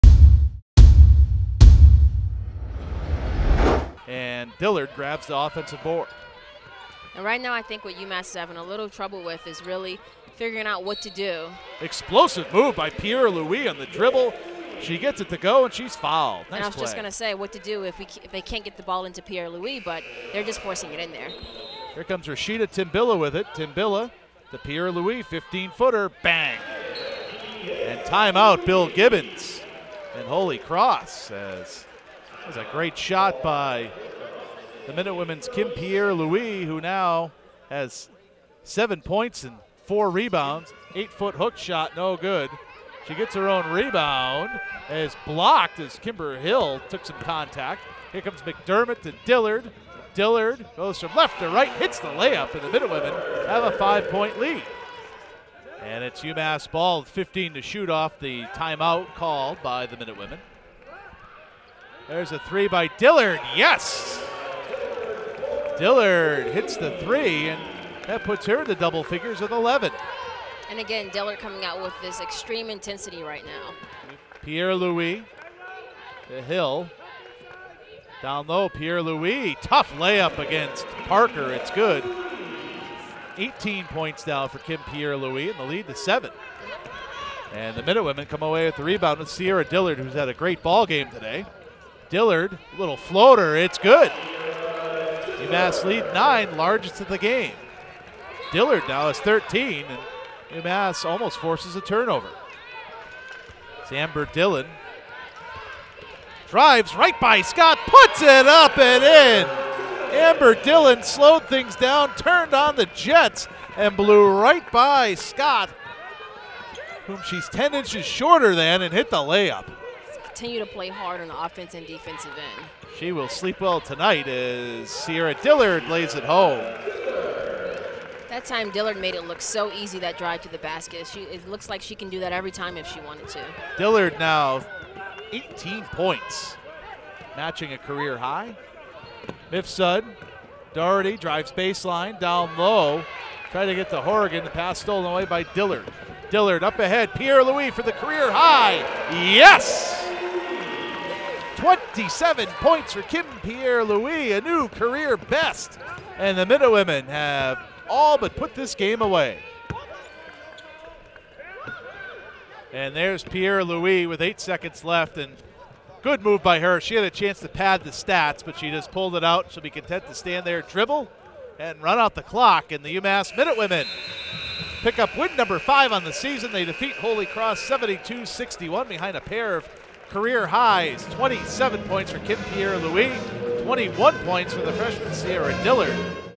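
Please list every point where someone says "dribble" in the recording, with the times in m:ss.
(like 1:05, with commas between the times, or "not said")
0:13, 2:50.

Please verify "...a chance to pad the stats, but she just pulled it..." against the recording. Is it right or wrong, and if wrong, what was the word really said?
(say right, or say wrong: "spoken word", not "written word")
right.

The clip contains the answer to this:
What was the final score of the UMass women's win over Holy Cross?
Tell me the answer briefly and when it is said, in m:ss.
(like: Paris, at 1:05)
72-61, at 2:57.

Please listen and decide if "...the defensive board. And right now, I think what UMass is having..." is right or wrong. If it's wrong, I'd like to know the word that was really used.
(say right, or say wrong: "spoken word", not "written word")
wrong: "offensive", not "defensive".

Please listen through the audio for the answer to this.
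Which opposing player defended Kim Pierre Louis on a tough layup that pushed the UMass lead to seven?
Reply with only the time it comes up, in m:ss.
1:21.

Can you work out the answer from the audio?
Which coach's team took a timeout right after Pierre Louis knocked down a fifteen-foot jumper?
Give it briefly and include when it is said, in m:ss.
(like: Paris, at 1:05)
Bill Gibbons, at 0:28.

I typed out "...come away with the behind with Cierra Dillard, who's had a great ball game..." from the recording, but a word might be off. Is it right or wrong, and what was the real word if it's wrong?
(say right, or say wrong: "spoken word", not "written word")
wrong: "rebound", not "behind".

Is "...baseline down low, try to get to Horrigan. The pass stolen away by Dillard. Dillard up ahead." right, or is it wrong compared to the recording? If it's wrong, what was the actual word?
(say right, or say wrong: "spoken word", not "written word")
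right.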